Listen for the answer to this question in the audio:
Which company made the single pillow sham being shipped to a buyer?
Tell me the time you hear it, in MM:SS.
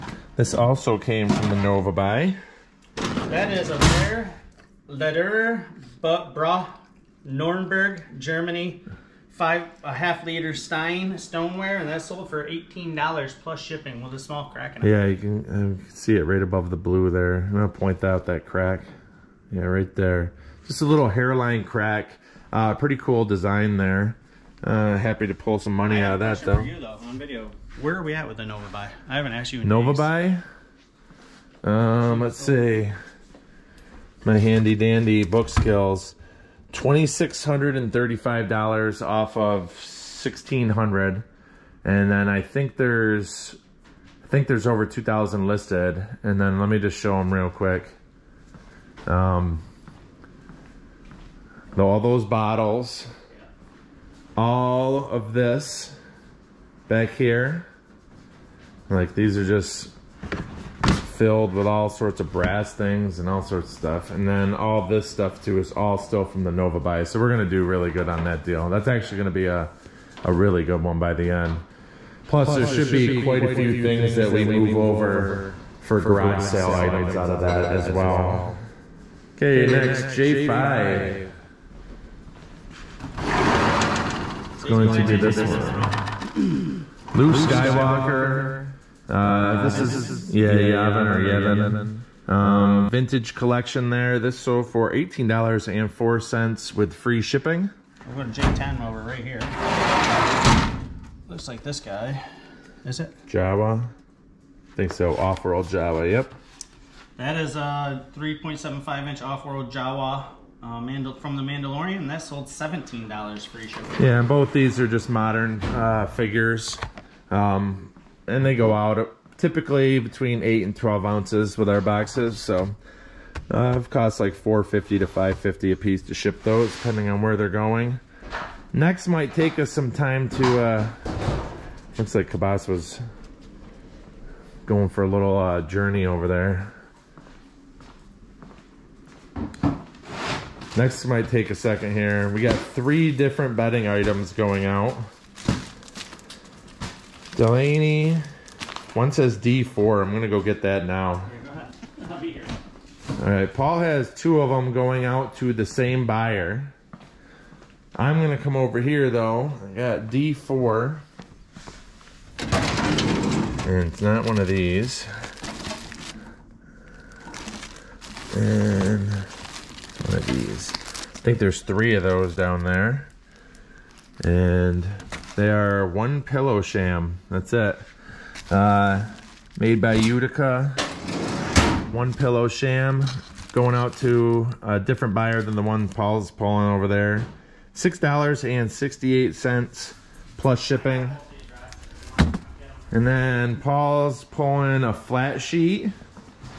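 02:59.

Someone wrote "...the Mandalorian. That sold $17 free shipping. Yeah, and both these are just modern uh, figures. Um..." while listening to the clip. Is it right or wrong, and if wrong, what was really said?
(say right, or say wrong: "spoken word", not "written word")
right.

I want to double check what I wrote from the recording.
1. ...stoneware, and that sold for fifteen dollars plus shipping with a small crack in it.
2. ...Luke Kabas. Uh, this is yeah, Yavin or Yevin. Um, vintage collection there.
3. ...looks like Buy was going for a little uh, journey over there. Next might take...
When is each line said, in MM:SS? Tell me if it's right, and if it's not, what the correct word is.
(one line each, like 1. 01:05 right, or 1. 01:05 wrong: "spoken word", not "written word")
1. 00:11 wrong: "eighteen", not "fifteen"
2. 01:27 wrong: "Skywalker", not "Kabas"
3. 02:11 wrong: "Kabas", not "Buy".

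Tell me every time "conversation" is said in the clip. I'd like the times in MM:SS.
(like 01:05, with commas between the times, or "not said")
not said.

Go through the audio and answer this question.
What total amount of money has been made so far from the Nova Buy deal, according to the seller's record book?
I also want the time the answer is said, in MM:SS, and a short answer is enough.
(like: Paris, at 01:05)
$2,635, at 00:36.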